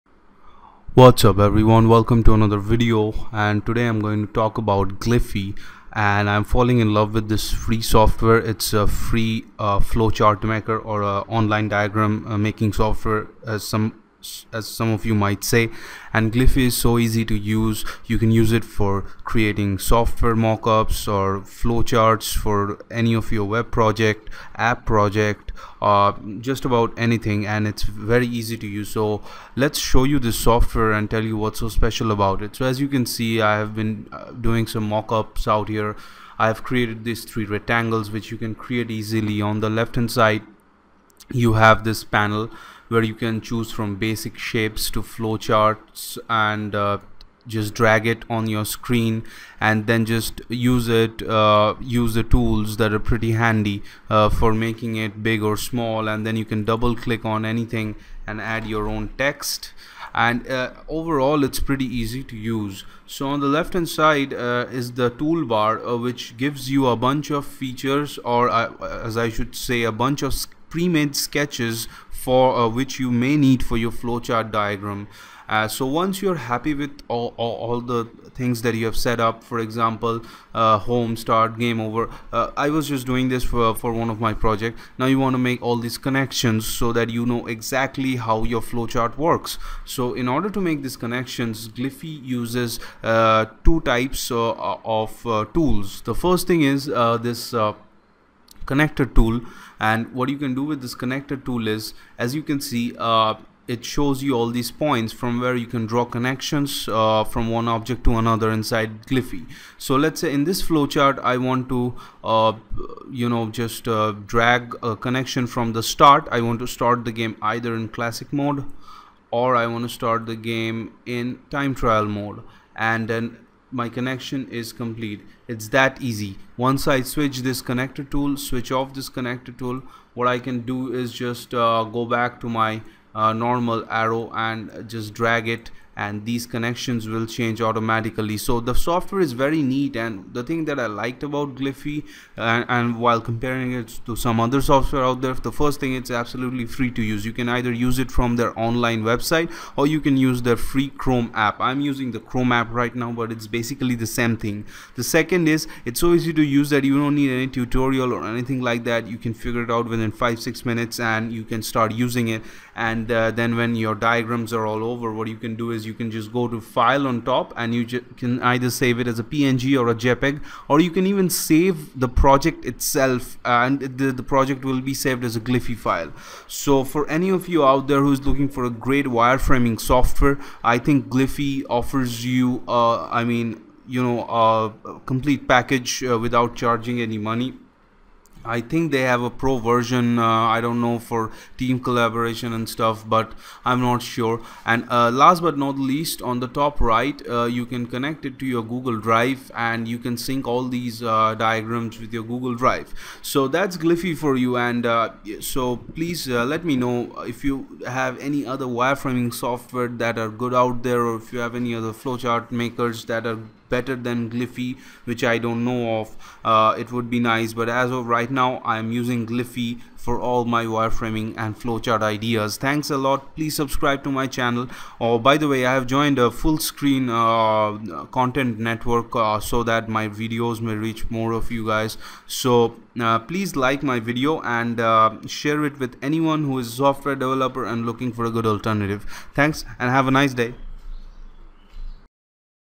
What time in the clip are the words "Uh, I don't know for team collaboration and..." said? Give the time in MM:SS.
03:10.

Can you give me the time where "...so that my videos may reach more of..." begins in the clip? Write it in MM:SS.
03:49.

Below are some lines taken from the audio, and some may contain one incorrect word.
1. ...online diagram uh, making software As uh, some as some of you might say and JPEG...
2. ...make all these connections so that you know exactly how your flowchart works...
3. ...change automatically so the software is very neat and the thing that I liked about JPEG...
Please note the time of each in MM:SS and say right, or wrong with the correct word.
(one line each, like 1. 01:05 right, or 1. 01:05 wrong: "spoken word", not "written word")
1. 00:11 wrong: "Gliffy", not "JPEG"
2. 01:25 right
3. 02:17 wrong: "Gliffy", not "JPEG".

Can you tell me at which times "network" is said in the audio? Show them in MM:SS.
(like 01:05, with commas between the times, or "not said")
03:48.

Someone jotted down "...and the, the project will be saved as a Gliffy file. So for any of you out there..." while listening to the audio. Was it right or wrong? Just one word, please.
right.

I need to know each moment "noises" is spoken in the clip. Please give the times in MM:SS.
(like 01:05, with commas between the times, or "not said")
not said.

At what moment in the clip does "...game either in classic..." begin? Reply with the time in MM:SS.
01:57.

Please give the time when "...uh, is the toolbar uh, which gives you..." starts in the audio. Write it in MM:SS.
01:04.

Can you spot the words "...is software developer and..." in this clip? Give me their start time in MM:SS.
03:56.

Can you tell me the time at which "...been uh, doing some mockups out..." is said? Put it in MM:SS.
00:33.